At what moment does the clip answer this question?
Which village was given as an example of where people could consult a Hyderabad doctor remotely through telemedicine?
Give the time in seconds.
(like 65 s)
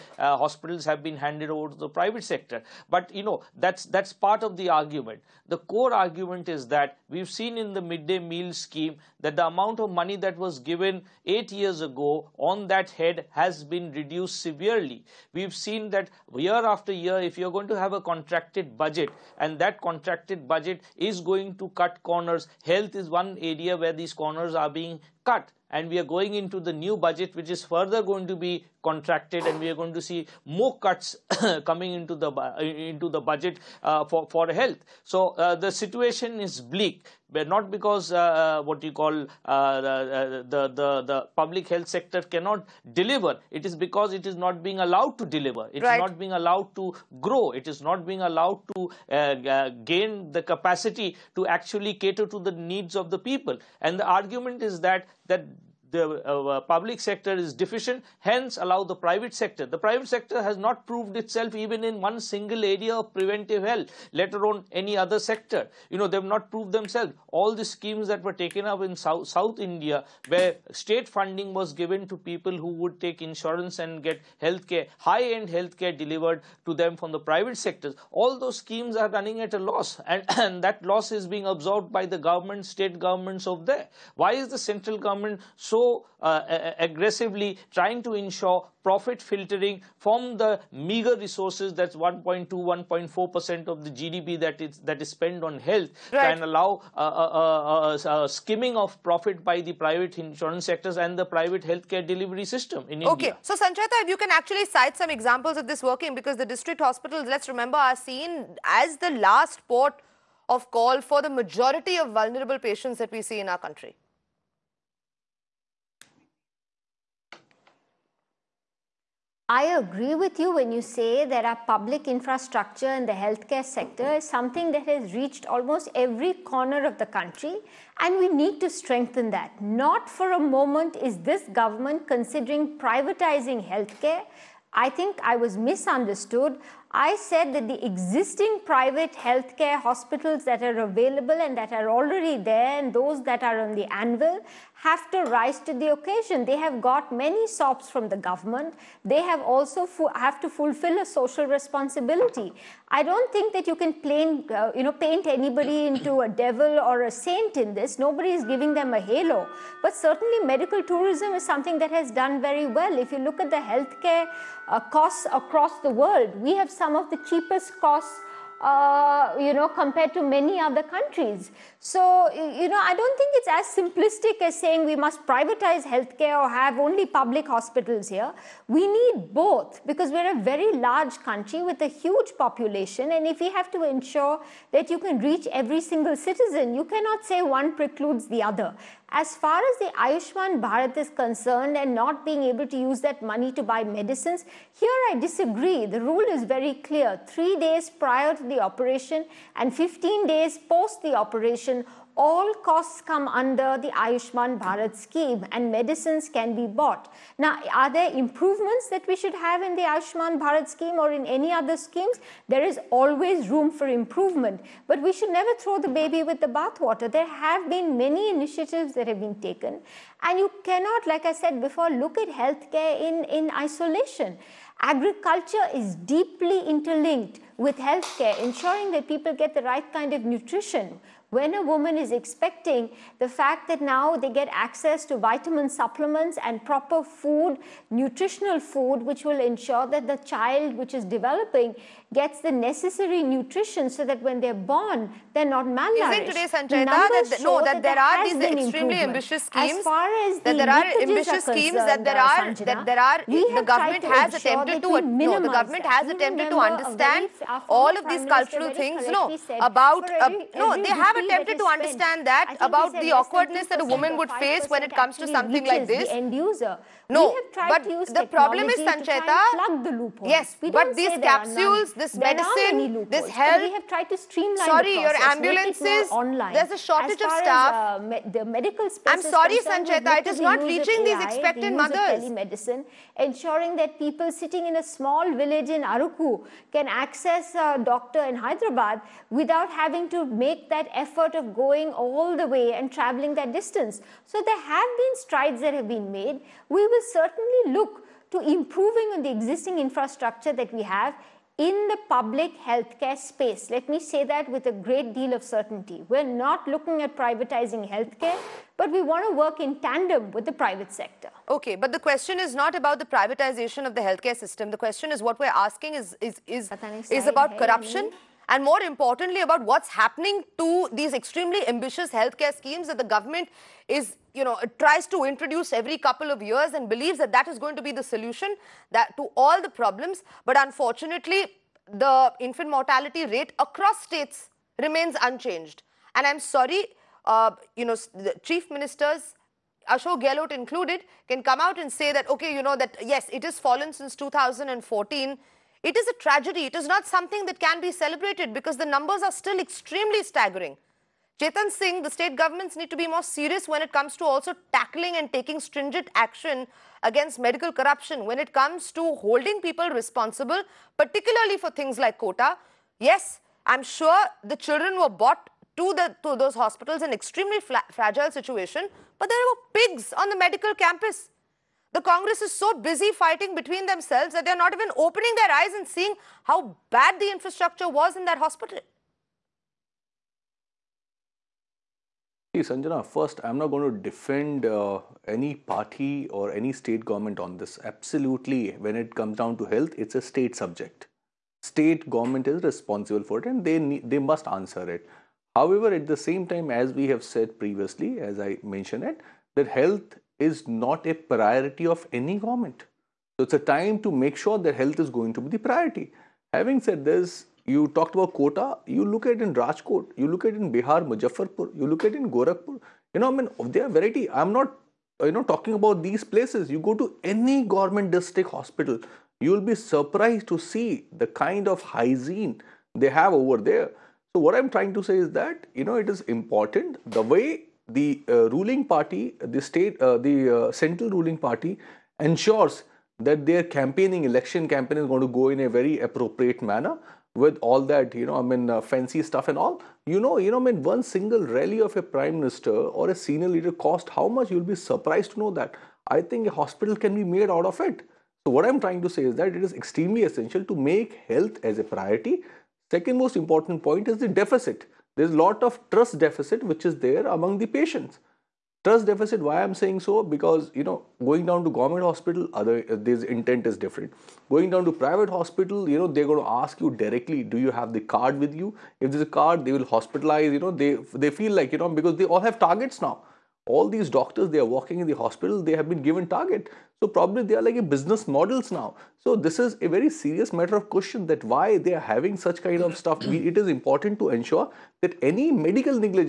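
285 s.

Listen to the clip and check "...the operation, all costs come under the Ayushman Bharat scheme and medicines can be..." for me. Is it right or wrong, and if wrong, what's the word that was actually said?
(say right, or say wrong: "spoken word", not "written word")
right.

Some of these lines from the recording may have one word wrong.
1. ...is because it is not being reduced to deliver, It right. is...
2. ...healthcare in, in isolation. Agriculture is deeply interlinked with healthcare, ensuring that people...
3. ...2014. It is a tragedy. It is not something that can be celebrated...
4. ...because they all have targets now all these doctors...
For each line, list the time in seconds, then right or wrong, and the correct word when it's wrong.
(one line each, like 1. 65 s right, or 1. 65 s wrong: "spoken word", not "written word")
1. 43 s wrong: "allowed", not "reduced"
2. 222 s right
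3. 344 s right
4. 471 s right.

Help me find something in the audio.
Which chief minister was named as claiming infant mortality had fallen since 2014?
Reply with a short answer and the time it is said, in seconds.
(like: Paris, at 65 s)
Ashok Gehlot, at 339 s.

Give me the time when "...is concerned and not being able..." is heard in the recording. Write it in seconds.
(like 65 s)
190 s.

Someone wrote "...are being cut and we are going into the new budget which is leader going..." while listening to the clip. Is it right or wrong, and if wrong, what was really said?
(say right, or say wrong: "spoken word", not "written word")
wrong: "further", not "leader".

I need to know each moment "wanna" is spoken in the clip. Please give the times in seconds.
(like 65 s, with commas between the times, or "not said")
not said.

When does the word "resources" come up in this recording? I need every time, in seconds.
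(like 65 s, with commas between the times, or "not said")
91 s.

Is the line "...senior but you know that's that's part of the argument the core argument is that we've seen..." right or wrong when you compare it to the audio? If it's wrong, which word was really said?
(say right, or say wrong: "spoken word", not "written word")
wrong: "sector", not "senior".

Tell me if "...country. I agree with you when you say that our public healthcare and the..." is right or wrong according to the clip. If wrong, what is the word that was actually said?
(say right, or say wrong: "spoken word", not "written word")
wrong: "infrastructure", not "healthcare".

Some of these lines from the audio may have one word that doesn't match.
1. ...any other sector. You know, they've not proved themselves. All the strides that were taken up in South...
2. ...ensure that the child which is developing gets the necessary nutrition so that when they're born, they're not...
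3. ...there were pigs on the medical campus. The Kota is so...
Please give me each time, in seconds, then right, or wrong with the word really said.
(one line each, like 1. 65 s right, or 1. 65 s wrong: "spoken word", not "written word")
1. 64 s wrong: "schemes", not "strides"
2. 239 s right
3. 369 s wrong: "Congress", not "Kota".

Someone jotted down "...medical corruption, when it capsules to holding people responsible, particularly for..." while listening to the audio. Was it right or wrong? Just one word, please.
wrong.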